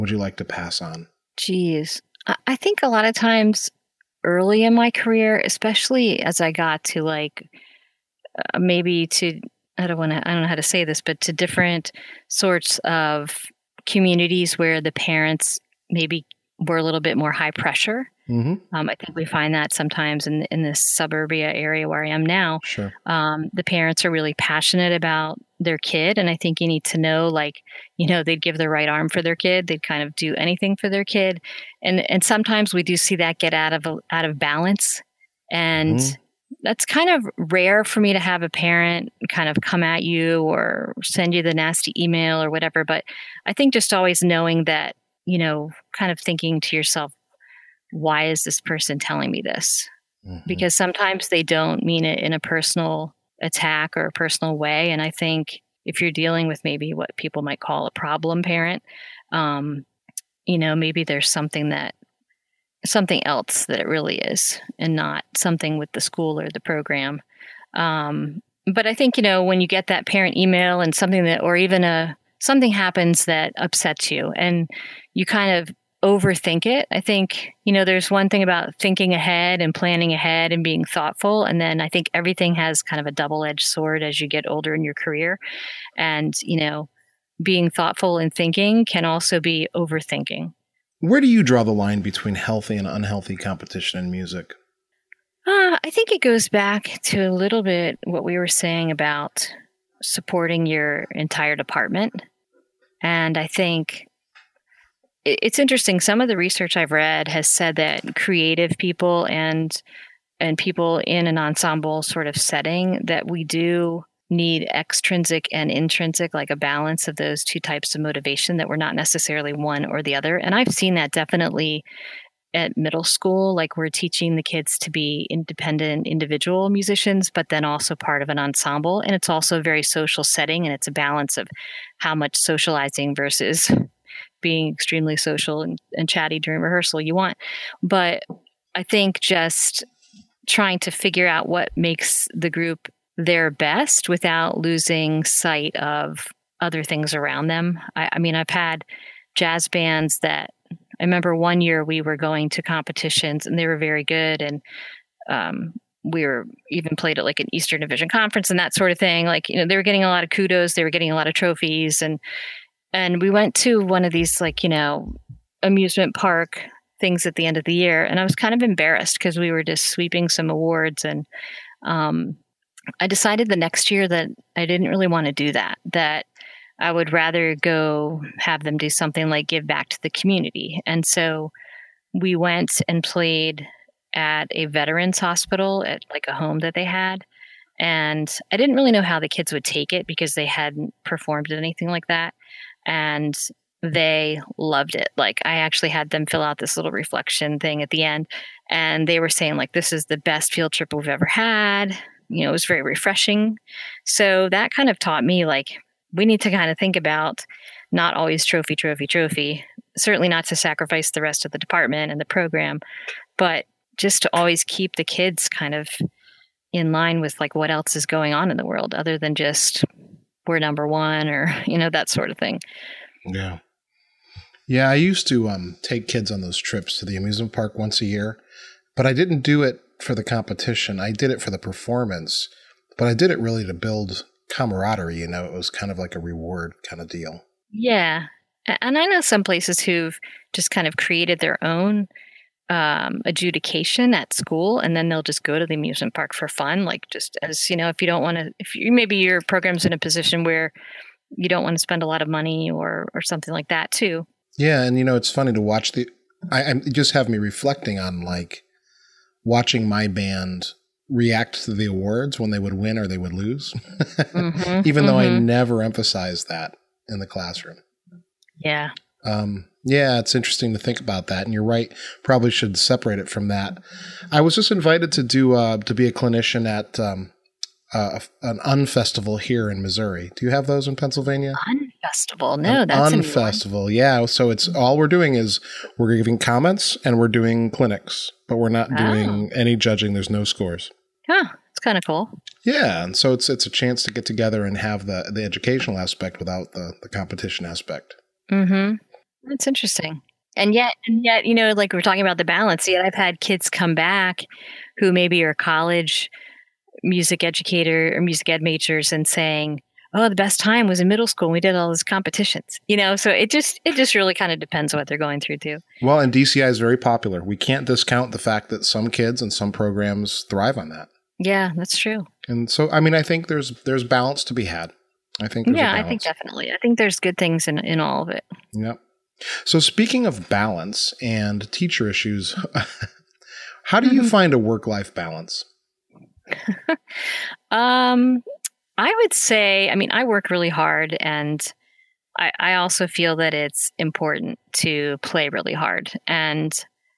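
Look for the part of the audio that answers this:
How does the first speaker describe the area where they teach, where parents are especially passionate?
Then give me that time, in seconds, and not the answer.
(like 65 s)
20 s.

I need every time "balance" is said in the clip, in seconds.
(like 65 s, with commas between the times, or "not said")
34 s, 116 s, 130 s, 302 s, 324 s, 330 s, 335 s.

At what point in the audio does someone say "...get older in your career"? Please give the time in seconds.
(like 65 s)
84 s.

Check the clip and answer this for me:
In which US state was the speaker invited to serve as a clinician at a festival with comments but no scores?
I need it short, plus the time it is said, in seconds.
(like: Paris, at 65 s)
Missouri, at 279 s.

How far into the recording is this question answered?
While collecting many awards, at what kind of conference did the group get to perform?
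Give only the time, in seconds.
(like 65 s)
157 s.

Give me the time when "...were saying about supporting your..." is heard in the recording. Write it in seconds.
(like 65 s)
98 s.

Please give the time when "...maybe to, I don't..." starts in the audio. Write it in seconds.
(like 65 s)
8 s.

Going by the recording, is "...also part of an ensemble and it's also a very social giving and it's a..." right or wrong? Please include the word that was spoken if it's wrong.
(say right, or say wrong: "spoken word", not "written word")
wrong: "setting", not "giving".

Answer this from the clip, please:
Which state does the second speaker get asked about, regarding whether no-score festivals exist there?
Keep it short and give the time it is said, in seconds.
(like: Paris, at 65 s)
Pennsylvania, at 280 s.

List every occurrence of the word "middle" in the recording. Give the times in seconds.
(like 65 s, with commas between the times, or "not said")
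122 s, 311 s.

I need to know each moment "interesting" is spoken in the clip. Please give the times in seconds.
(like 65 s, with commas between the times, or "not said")
105 s, 270 s, 299 s.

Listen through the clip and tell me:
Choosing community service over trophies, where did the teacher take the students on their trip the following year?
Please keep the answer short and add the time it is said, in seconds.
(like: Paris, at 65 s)
veterans hospital, at 184 s.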